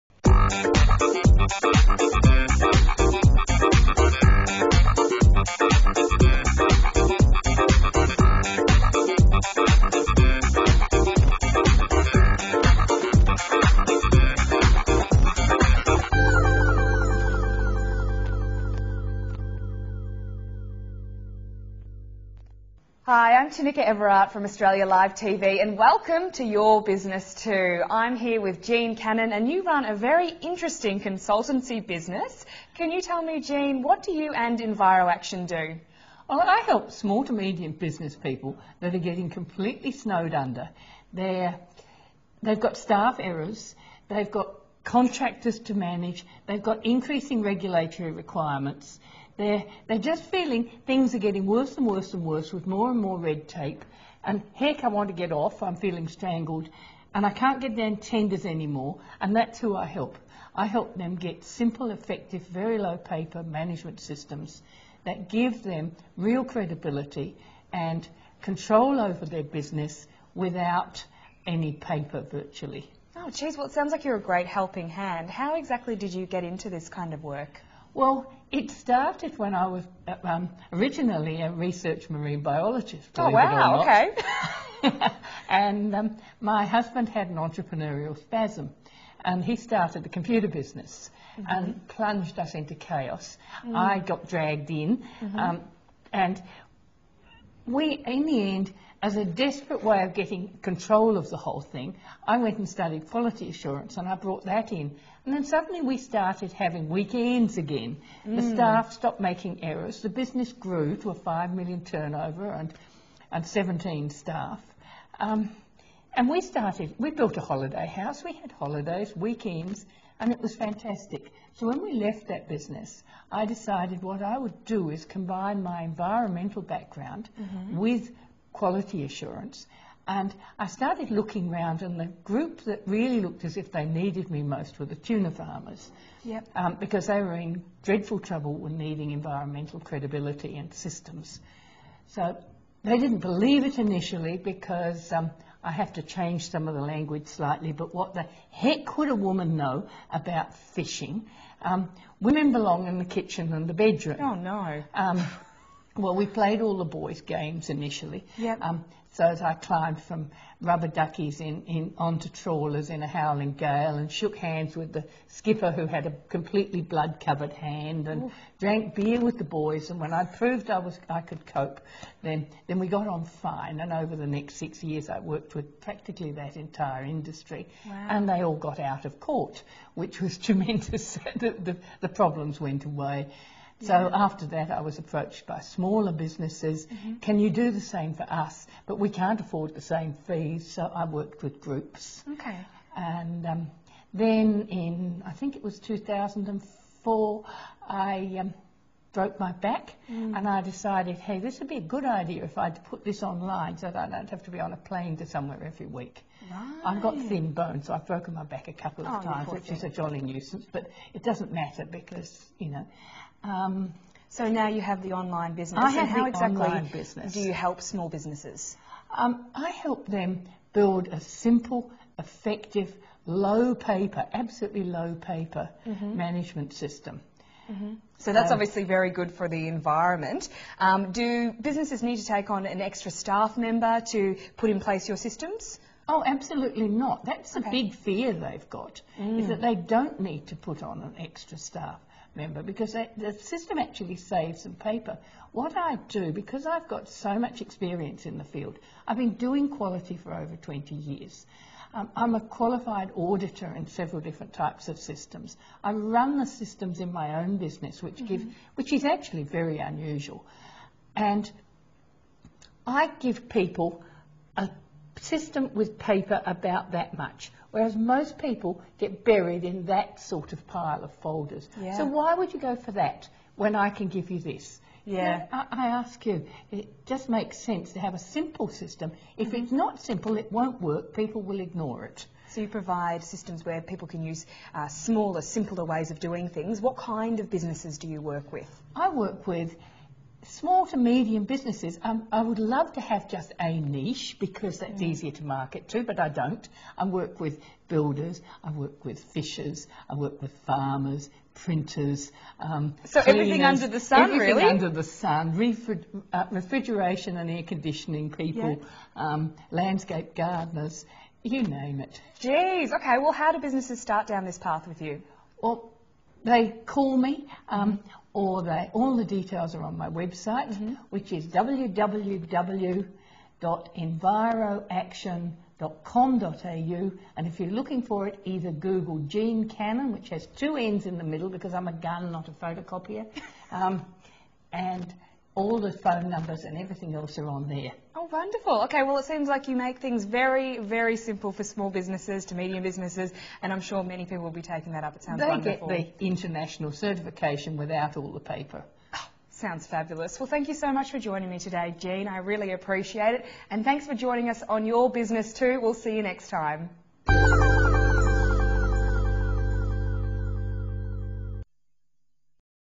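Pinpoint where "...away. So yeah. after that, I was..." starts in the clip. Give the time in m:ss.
3:02.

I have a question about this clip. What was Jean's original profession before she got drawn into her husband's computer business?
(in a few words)
Research marine biologist.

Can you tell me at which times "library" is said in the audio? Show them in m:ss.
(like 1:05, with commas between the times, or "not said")
not said.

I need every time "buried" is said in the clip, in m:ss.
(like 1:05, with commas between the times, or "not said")
4:29.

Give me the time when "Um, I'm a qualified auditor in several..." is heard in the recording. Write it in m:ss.
4:11.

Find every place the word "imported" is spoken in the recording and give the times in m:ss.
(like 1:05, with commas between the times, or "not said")
not said.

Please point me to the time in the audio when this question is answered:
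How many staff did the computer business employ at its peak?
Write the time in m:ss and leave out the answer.
1:53.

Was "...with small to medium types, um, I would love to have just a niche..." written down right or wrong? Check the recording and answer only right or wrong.
wrong.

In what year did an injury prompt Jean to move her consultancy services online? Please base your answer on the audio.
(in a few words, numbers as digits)
2004.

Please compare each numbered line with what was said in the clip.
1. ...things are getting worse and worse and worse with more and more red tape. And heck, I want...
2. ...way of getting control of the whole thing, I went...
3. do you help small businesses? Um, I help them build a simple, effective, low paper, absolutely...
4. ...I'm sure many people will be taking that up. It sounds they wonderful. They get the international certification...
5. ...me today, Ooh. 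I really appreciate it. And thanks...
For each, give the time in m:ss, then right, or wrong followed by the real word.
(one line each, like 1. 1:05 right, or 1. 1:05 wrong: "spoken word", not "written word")
1. 0:50 right
2. 1:39 right
3. 3:37 right
4. 5:43 right
5. 5:51 wrong: "Jean", not "Ooh".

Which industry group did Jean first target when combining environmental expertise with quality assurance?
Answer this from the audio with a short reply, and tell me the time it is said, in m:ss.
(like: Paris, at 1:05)
Tuna farmers, at 2:14.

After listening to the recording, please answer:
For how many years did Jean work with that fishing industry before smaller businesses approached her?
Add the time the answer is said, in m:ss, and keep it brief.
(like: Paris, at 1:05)
6, at 2:54.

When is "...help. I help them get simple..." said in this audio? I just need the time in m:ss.
0:59.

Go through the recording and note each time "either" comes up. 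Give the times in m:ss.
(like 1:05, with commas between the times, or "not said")
5:28.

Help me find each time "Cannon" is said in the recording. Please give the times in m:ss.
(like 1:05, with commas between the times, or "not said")
0:28, 5:29.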